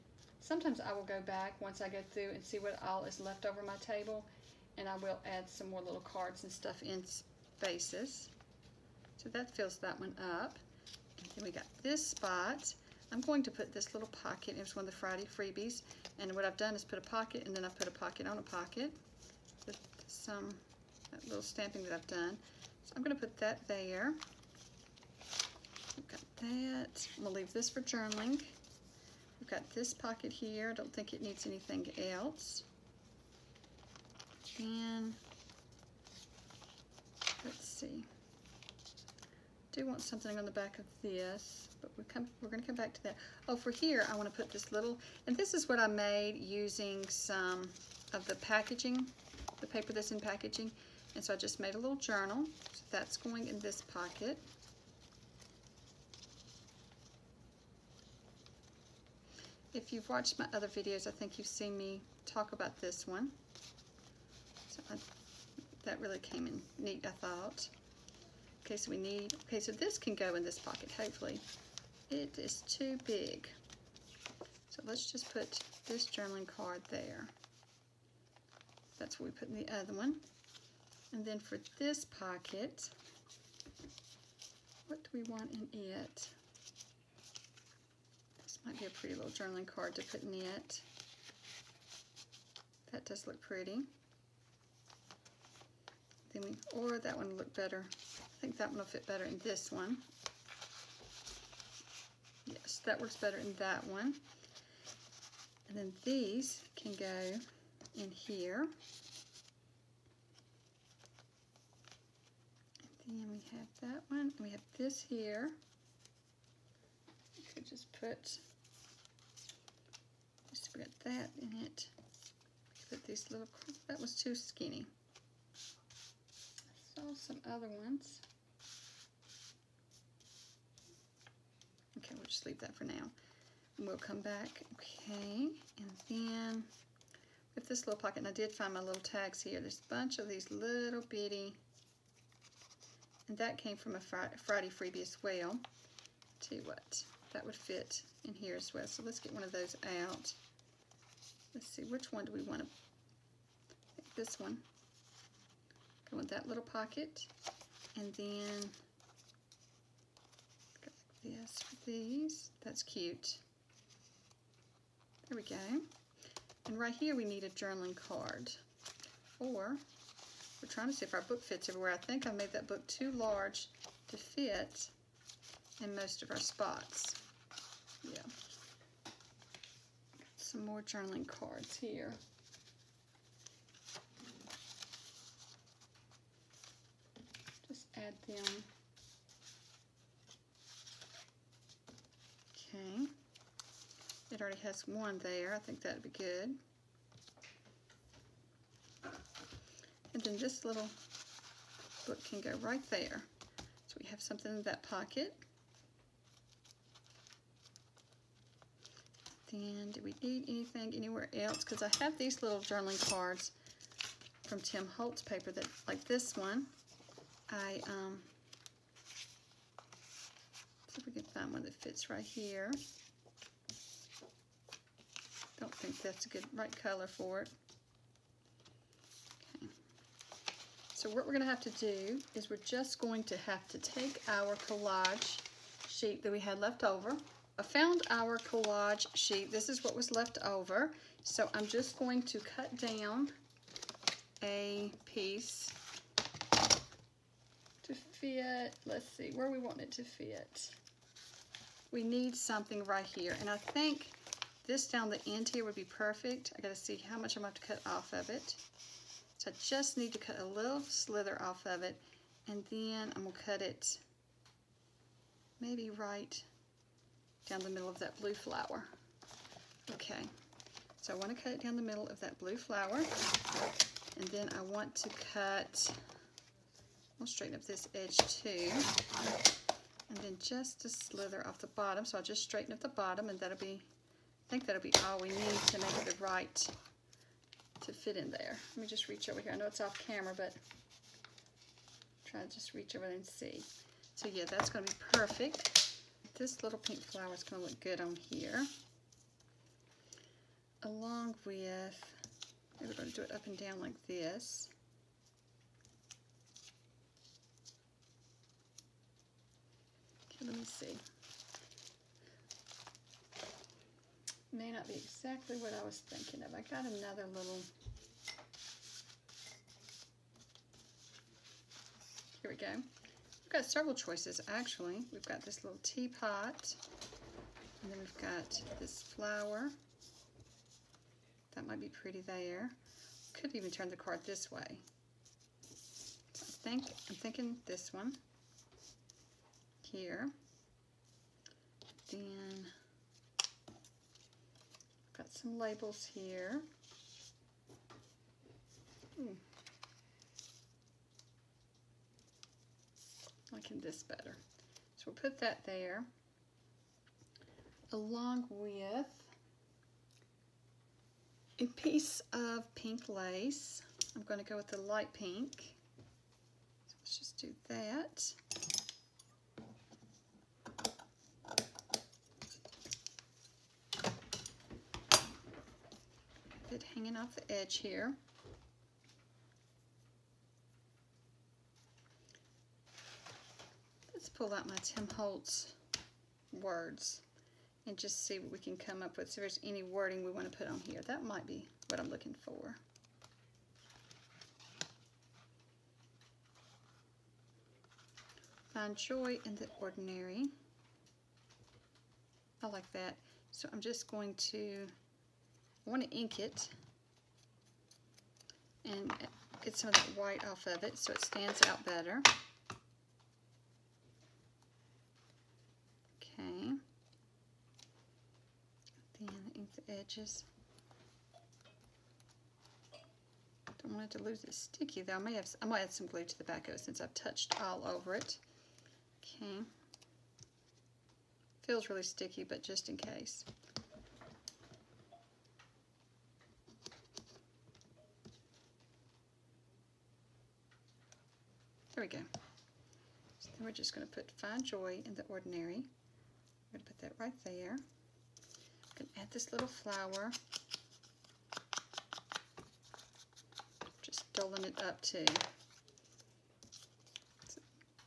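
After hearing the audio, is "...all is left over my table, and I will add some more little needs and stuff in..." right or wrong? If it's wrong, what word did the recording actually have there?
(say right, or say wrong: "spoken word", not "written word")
wrong: "cards", not "needs".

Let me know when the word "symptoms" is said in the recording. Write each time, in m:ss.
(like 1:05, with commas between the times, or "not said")
not said.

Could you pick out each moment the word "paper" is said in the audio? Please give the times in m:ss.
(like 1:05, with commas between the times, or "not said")
0:49, 3:35.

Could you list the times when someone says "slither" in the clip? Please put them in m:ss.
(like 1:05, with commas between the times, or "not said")
4:20, 4:40.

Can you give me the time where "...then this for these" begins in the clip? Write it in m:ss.
2:38.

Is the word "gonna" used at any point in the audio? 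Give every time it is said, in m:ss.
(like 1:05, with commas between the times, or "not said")
0:27, 0:42, 3:51, 4:17, 4:23, 4:54, 7:05, 7:28.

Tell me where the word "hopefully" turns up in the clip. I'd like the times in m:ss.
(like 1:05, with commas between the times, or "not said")
1:10.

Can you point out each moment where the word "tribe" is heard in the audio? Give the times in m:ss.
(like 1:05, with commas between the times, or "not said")
not said.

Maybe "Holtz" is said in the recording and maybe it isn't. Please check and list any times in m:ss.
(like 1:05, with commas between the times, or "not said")
3:34, 6:25.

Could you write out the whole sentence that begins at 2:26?
tell you what, that would fit in here as well.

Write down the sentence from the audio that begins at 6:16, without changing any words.
It hanging off the edge here.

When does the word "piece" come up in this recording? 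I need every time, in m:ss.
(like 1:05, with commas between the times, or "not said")
4:05, 6:01.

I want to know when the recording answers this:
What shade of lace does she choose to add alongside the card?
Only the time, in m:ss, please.
6:04.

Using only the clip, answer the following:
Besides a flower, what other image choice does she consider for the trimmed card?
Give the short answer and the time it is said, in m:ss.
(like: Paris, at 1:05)
teapot, at 5:25.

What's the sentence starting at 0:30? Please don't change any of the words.
I don't think it needs anything else.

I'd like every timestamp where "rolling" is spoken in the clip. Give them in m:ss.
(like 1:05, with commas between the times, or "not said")
not said.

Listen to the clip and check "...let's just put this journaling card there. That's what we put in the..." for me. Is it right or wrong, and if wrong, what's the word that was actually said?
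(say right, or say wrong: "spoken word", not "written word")
right.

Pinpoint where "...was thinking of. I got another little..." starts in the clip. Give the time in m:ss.
5:15.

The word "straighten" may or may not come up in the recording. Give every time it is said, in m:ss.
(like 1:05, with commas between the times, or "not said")
4:37, 4:42.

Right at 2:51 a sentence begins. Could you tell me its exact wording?
I think I made that book too large to fit in most of our spots.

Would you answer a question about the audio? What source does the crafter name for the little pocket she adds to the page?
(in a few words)
Friday freebies.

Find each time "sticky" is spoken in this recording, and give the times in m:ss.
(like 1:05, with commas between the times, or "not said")
7:04, 7:12.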